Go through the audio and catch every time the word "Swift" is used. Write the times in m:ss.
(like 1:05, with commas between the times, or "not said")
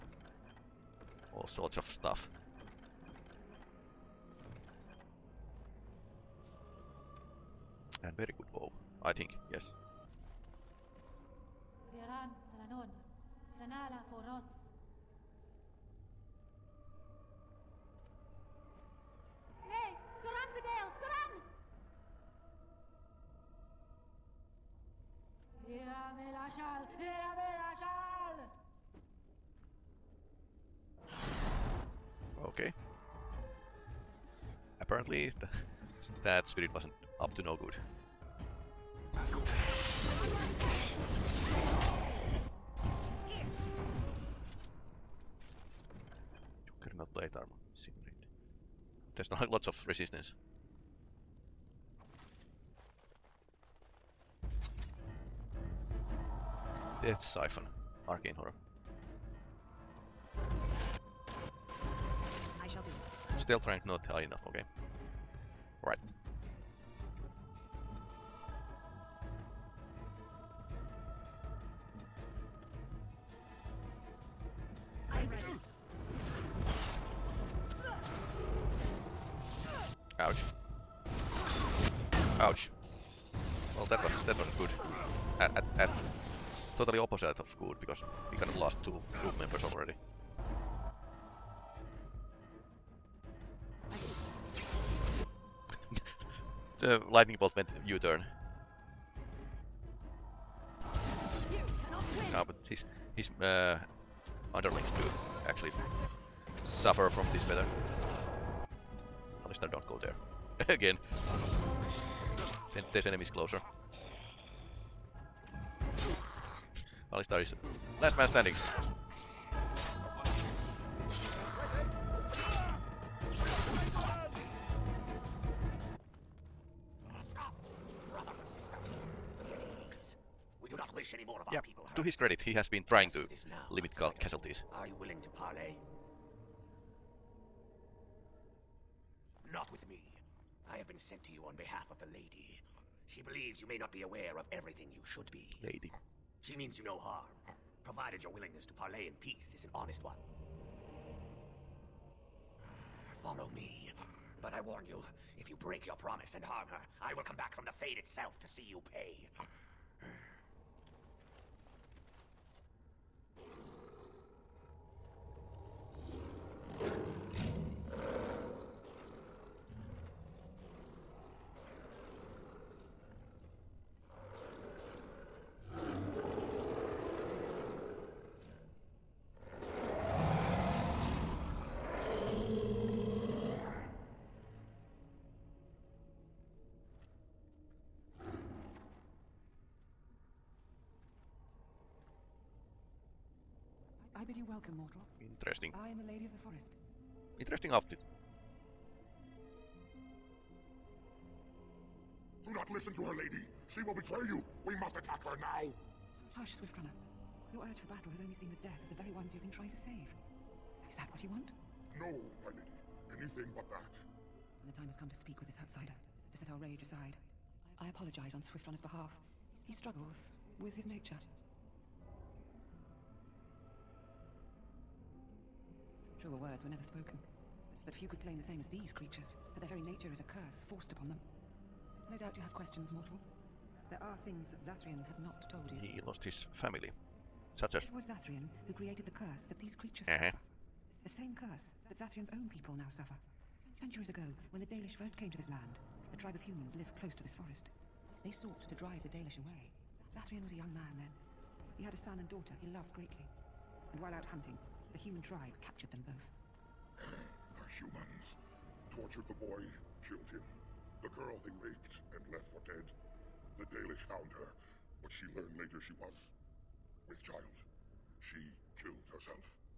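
3:26, 3:38.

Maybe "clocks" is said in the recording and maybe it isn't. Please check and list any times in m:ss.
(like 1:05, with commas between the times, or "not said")
not said.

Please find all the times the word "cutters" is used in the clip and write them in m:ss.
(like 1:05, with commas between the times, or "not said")
not said.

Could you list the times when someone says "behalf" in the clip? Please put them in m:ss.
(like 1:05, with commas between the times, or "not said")
2:21, 3:38.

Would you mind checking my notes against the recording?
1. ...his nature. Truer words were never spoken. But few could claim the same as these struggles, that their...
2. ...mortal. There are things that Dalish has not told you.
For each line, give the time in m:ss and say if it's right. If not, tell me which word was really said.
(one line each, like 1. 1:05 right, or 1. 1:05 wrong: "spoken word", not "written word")
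1. 3:40 wrong: "creatures", not "struggles"
2. 3:52 wrong: "Zathrian", not "Dalish".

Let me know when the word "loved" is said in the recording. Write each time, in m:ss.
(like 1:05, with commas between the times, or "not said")
4:12.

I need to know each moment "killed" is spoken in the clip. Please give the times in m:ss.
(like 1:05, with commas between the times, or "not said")
4:20, 4:28.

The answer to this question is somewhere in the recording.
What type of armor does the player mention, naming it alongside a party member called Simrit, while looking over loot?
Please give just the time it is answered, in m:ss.
0:46.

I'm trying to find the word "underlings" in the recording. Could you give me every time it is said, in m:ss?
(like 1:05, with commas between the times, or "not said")
1:44.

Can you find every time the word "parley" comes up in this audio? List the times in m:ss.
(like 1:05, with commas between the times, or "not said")
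2:15, 2:28.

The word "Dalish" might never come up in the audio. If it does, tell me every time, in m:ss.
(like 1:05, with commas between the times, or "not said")
4:04, 4:09, 4:23.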